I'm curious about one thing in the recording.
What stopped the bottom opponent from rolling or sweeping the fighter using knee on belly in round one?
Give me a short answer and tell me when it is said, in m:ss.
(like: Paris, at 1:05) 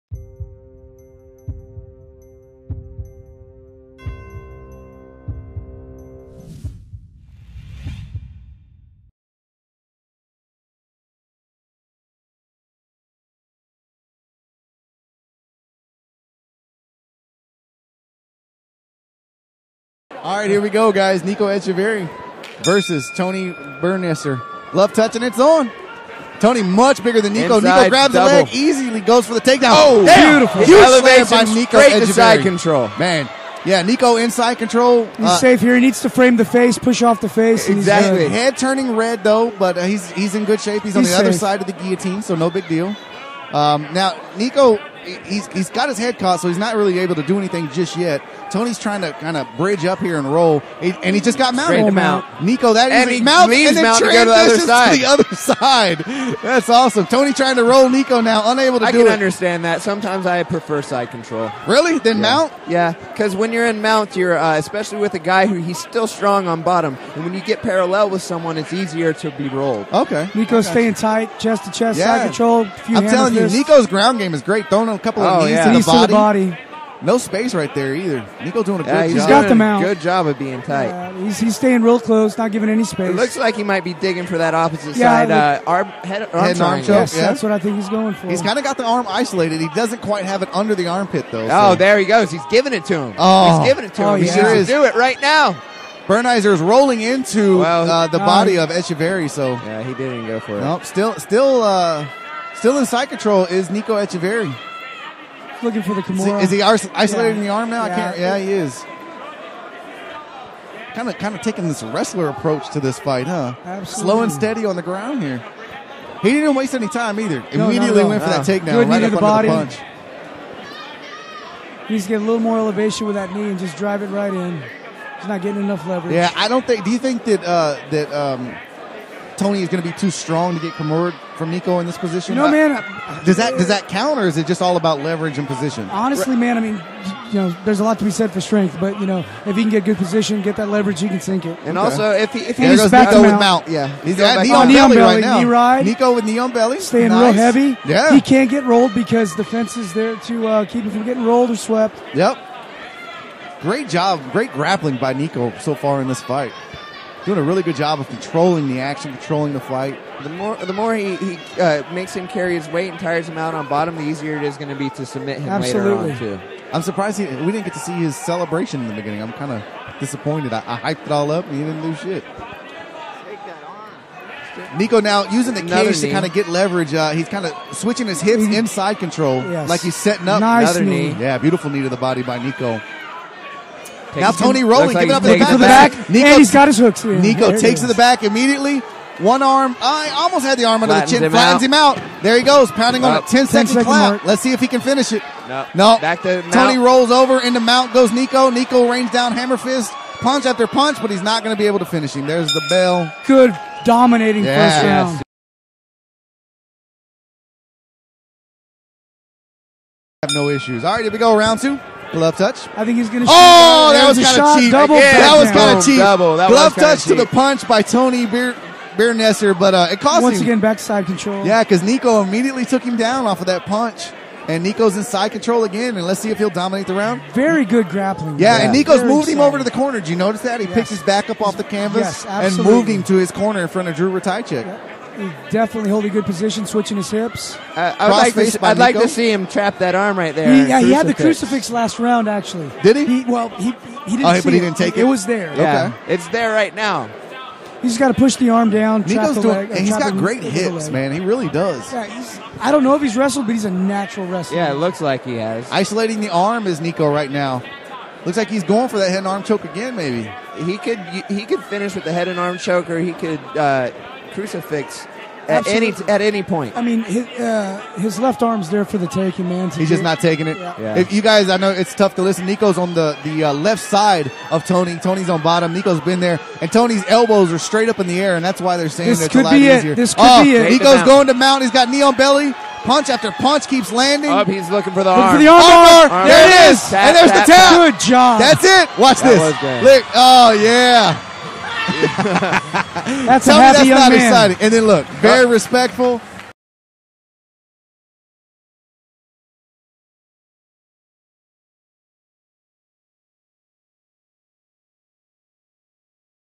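The fence, at 2:29.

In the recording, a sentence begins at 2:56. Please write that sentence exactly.
Uh, he's kind of switching his hips mm-hmm.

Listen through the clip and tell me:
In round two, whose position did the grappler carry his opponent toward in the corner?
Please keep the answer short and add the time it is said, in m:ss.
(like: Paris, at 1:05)
Drew Ratajczyk, at 3:53.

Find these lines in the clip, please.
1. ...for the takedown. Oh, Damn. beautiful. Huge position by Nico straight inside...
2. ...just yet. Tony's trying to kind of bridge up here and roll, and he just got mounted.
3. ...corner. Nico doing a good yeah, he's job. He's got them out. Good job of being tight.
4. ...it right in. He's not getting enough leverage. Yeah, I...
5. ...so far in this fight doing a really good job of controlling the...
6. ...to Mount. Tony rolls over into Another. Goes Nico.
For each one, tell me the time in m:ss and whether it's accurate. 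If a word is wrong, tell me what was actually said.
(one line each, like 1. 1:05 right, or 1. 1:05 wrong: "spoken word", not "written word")
1. 0:29 wrong: "elevation", not "position"
2. 0:47 right
3. 1:17 wrong: "either", not "corner"
4. 2:04 right
5. 2:35 right
6. 3:16 wrong: "Mount", not "Another".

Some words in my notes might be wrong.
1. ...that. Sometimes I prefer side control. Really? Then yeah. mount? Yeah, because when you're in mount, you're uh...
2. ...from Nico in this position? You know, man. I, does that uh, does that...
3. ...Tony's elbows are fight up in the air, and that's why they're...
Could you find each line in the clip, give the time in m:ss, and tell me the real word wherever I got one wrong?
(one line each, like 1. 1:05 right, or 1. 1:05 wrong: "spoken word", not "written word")
1. 0:59 right
2. 2:11 right
3. 4:36 wrong: "straight", not "fight".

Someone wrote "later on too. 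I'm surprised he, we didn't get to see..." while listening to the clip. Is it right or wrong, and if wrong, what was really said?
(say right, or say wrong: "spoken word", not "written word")
right.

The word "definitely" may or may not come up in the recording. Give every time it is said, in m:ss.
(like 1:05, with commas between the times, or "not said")
3:55.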